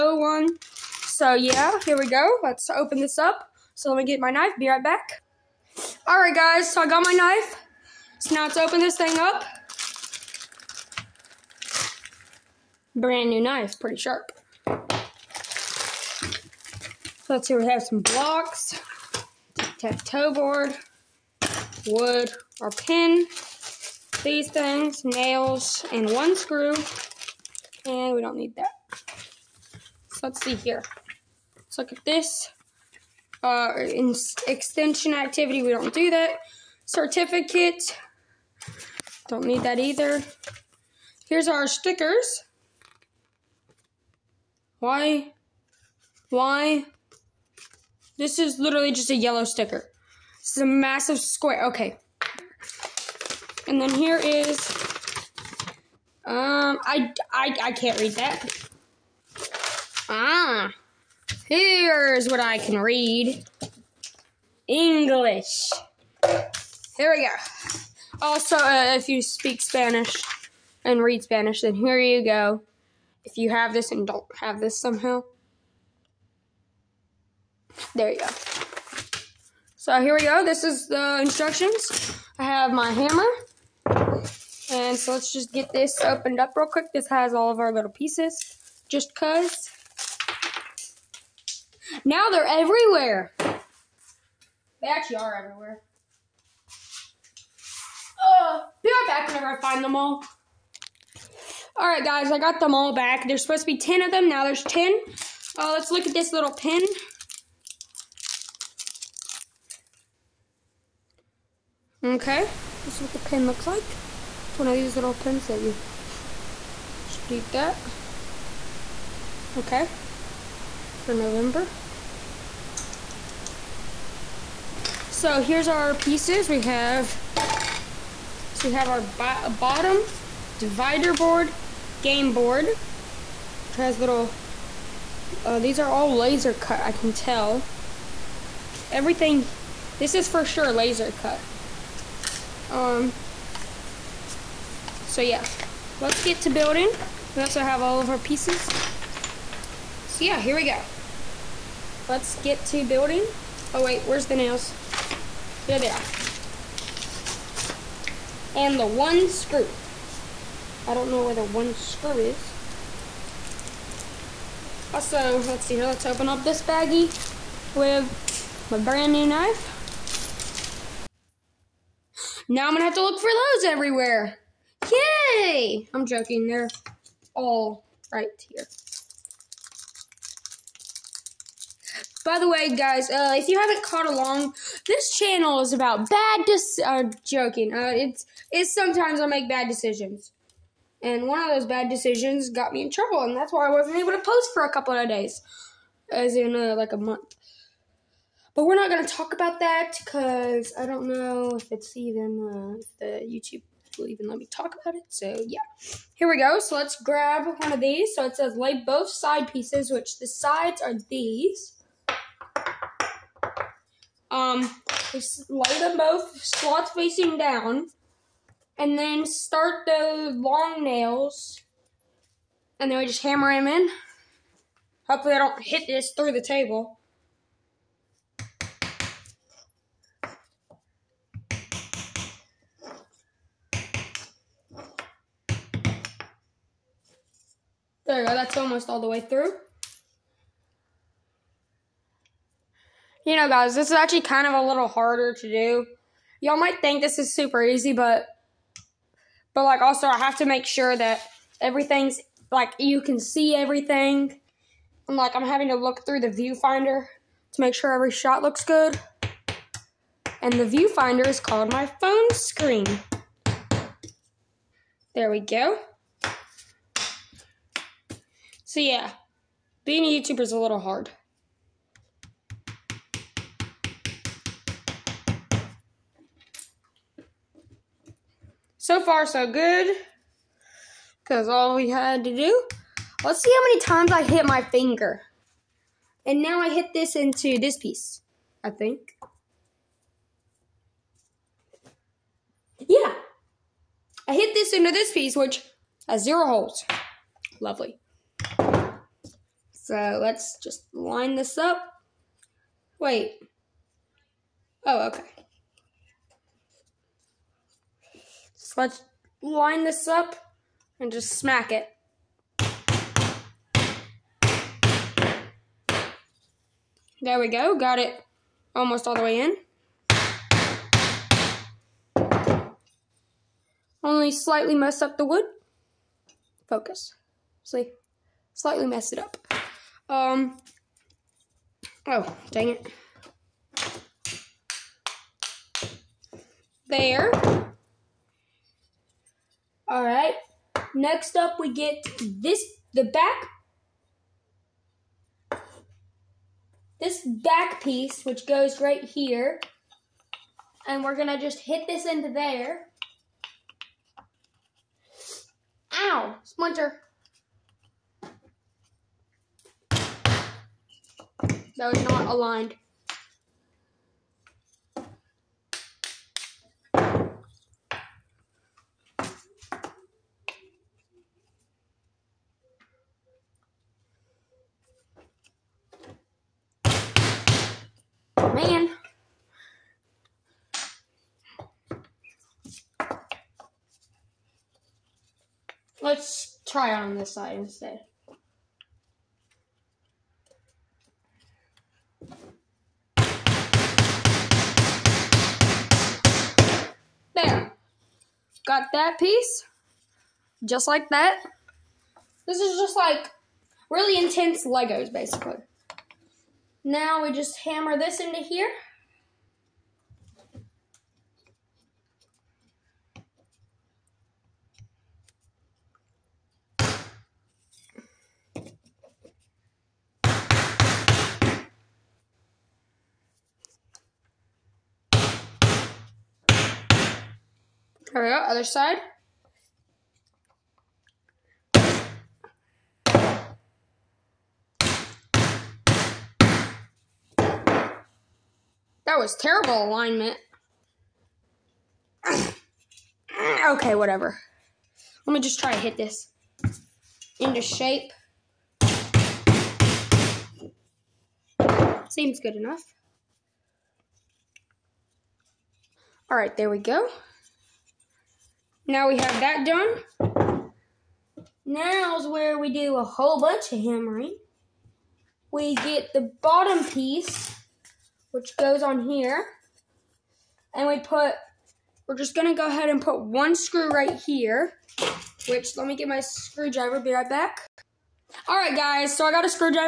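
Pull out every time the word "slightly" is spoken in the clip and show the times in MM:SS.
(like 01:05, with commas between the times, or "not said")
05:24, 05:28.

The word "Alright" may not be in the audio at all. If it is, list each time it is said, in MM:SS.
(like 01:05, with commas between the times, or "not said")
01:41.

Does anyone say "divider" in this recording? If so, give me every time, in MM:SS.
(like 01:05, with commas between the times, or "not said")
02:10.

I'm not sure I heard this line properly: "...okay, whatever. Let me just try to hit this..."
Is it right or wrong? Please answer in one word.
right.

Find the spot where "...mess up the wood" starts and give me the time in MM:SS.
05:24.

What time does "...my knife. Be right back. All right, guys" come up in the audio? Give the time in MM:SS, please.
00:04.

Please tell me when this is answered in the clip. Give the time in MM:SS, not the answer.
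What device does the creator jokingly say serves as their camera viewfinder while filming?
04:21.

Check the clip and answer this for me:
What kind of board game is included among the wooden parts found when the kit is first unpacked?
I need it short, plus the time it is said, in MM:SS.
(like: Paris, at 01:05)
tic-tac-toe, at 00:19.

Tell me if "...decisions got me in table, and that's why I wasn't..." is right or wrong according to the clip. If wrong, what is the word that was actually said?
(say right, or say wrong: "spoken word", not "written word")
wrong: "trouble", not "table".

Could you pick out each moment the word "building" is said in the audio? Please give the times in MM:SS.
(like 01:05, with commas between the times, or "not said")
02:26, 02:32.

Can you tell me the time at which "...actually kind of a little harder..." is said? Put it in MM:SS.
04:03.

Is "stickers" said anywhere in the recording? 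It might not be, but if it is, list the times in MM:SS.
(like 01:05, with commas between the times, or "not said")
00:41, 00:49.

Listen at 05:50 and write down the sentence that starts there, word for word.
And we're going to just hit this into there.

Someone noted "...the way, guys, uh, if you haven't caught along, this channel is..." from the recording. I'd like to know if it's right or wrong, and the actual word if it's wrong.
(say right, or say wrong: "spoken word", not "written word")
right.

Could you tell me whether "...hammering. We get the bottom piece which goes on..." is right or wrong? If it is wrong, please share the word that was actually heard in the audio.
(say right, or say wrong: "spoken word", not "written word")
right.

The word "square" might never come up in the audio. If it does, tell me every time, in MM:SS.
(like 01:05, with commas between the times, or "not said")
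00:51.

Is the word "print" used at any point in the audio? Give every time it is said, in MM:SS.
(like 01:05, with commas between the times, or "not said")
not said.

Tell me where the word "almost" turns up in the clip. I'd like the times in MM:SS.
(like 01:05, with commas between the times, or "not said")
03:58, 05:18.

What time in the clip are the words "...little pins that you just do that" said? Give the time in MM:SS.
01:54.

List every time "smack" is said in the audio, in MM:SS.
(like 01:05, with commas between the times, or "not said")
05:11.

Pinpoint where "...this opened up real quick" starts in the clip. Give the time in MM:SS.
01:25.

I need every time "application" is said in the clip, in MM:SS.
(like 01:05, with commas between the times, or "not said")
not said.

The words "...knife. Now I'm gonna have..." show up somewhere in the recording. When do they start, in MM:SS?
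02:49.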